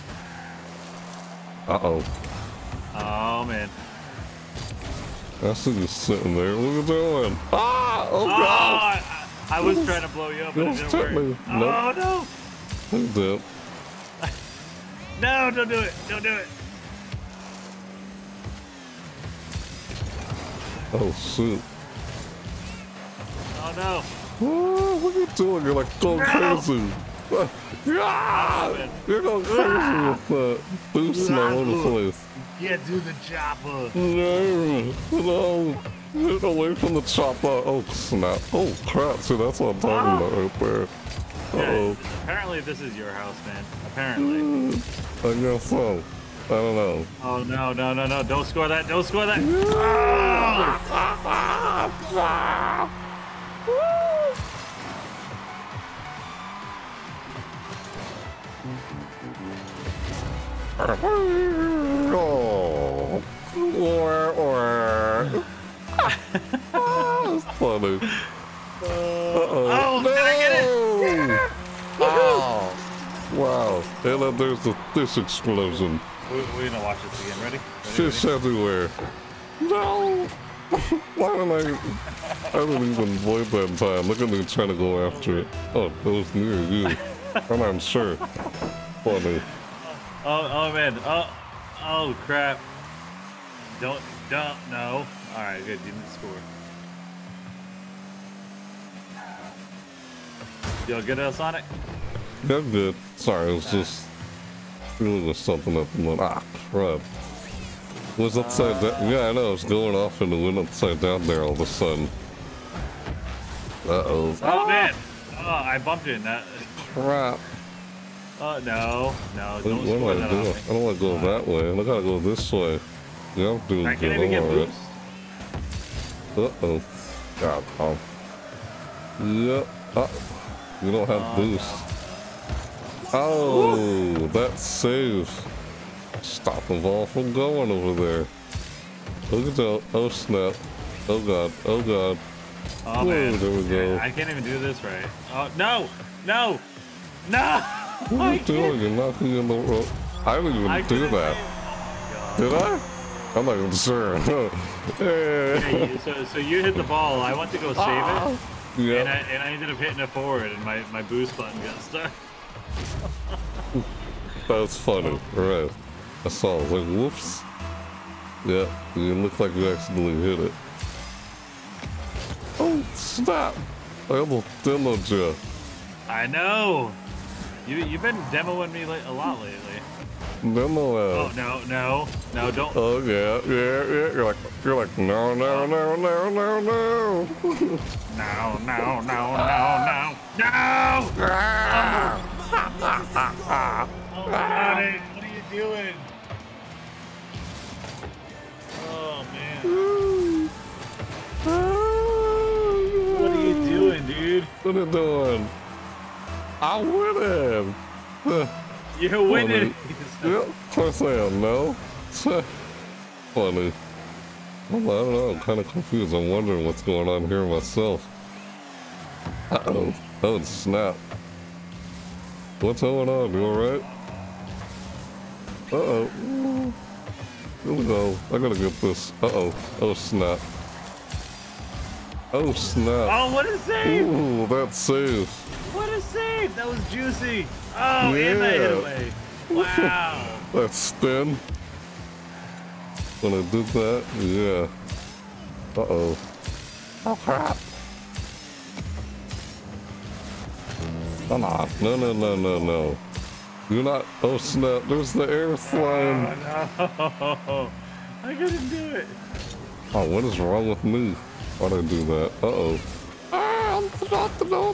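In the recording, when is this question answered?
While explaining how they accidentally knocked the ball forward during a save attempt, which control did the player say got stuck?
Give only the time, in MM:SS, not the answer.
02:41.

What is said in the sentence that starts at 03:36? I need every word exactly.
I'm wondering what's going on here myself.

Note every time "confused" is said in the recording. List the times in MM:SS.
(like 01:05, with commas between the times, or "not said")
03:35.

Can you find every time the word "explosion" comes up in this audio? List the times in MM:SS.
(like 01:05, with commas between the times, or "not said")
01:15.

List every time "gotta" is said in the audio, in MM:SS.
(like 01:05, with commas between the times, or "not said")
02:01, 03:48.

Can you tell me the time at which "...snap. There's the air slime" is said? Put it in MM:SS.
04:14.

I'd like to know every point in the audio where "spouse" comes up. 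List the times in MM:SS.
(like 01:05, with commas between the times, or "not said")
not said.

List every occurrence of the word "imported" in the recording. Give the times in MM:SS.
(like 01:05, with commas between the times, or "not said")
not said.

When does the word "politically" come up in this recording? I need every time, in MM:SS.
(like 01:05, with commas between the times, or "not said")
not said.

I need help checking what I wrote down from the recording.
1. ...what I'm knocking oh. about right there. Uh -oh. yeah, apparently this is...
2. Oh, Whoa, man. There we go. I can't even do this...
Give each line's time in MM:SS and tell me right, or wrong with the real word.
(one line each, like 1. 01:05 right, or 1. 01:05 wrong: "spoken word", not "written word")
1. 00:39 wrong: "talking", not "knocking"
2. 02:22 right.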